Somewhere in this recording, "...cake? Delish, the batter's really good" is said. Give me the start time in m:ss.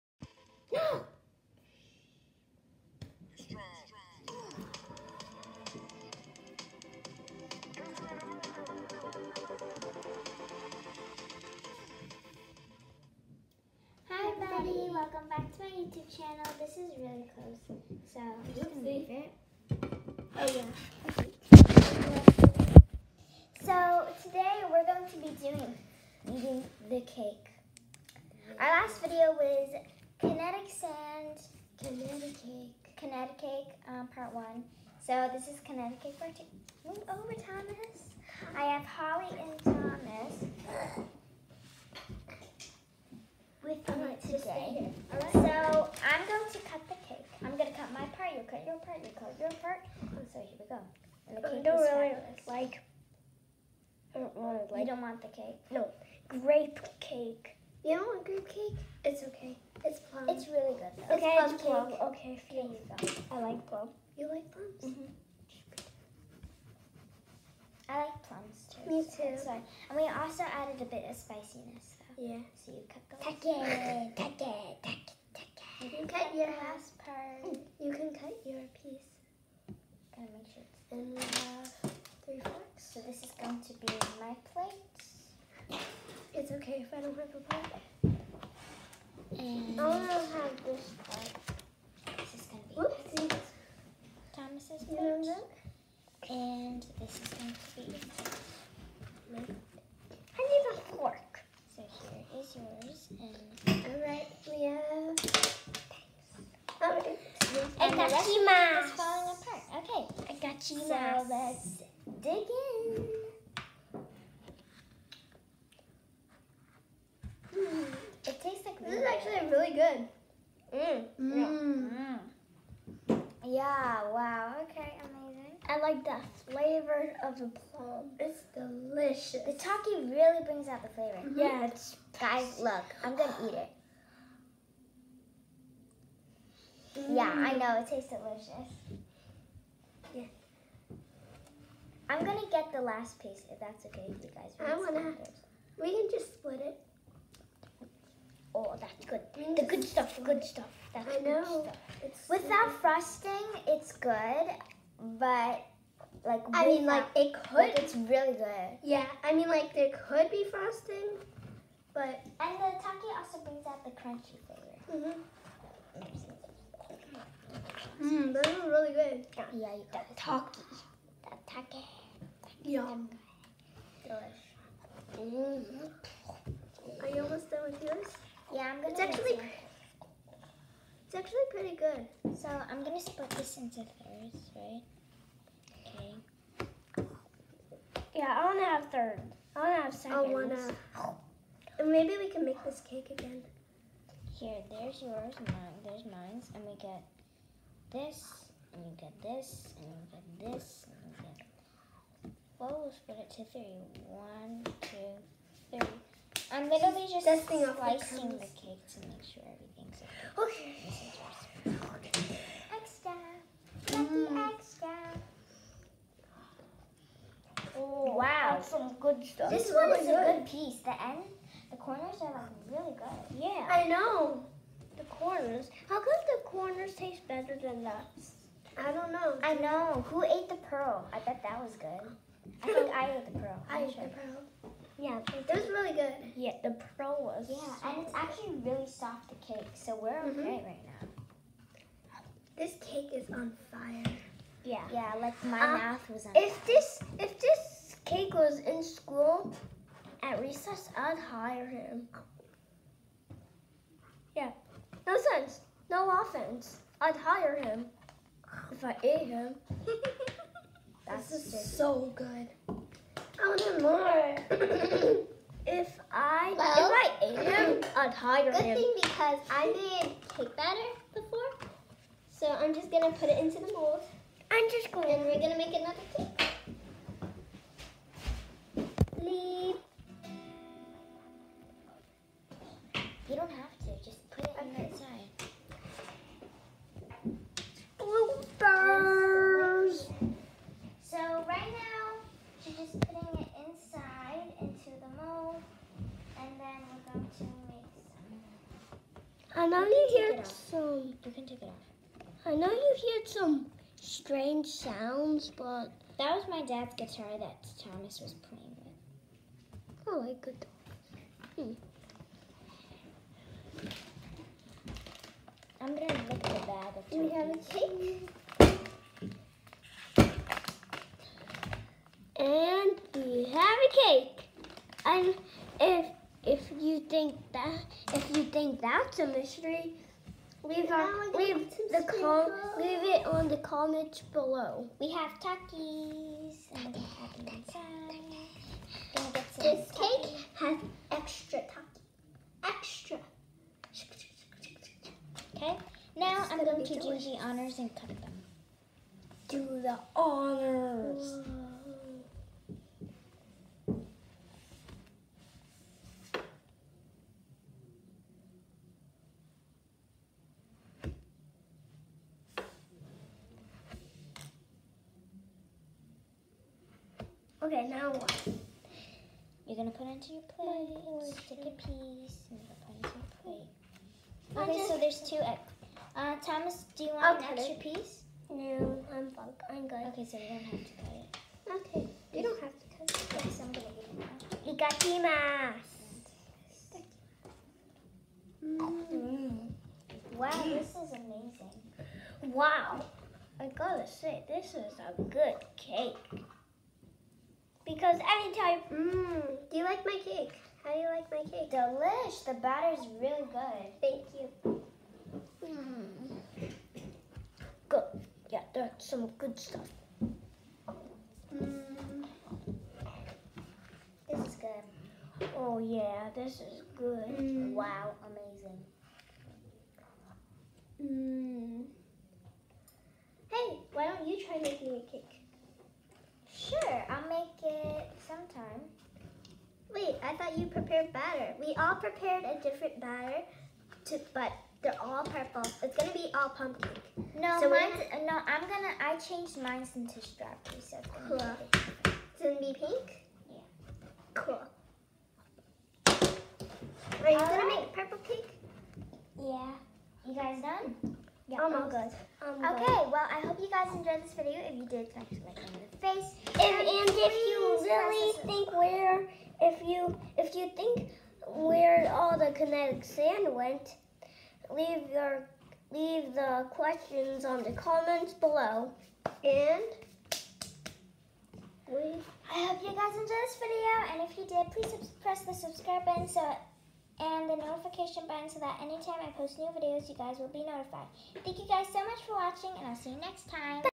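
6:41.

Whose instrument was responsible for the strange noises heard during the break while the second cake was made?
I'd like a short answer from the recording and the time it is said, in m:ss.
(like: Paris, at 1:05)
Dad's guitar, at 5:06.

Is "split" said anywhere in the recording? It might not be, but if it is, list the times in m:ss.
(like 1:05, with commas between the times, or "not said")
2:26, 3:02, 3:22.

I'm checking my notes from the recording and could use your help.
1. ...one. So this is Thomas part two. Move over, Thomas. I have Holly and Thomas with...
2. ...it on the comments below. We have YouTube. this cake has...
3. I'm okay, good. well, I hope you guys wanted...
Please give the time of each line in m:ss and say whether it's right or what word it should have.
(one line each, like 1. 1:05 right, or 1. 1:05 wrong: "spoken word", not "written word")
1. 0:34 wrong: "Kineticake", not "Thomas"
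2. 5:33 wrong: "Takis", not "YouTube"
3. 7:32 wrong: "enjoyed", not "wanted".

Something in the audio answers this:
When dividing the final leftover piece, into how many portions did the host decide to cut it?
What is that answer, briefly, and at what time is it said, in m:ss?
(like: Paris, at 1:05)
Thirds, at 3:03.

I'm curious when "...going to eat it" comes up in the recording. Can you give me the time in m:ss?
2:13.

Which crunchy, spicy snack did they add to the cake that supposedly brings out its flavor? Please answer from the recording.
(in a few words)
Takis.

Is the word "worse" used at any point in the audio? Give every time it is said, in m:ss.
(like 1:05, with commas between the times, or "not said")
not said.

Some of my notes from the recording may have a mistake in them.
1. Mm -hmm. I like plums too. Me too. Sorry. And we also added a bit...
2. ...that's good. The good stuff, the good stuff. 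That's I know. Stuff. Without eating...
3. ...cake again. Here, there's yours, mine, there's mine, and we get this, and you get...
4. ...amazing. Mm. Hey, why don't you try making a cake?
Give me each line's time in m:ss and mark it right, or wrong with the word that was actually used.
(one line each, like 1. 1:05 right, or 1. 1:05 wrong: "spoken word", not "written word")
1. 1:04 right
2. 2:28 wrong: "frosting", not "eating"
3. 3:12 right
4. 6:58 right.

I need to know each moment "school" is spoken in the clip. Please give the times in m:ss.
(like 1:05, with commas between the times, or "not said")
4:08.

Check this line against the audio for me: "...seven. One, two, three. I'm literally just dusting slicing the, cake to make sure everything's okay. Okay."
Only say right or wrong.
wrong.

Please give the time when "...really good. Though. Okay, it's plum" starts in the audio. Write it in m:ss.
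1:00.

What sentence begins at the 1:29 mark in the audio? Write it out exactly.
And I don't have this part.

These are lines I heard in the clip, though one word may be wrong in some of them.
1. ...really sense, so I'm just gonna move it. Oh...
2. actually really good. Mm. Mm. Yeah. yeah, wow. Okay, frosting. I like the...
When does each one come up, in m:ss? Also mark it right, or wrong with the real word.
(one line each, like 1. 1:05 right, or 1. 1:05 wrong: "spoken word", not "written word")
1. 0:16 wrong: "close", not "sense"
2. 1:59 wrong: "amazing", not "frosting".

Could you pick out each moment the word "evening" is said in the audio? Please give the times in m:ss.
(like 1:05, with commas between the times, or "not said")
not said.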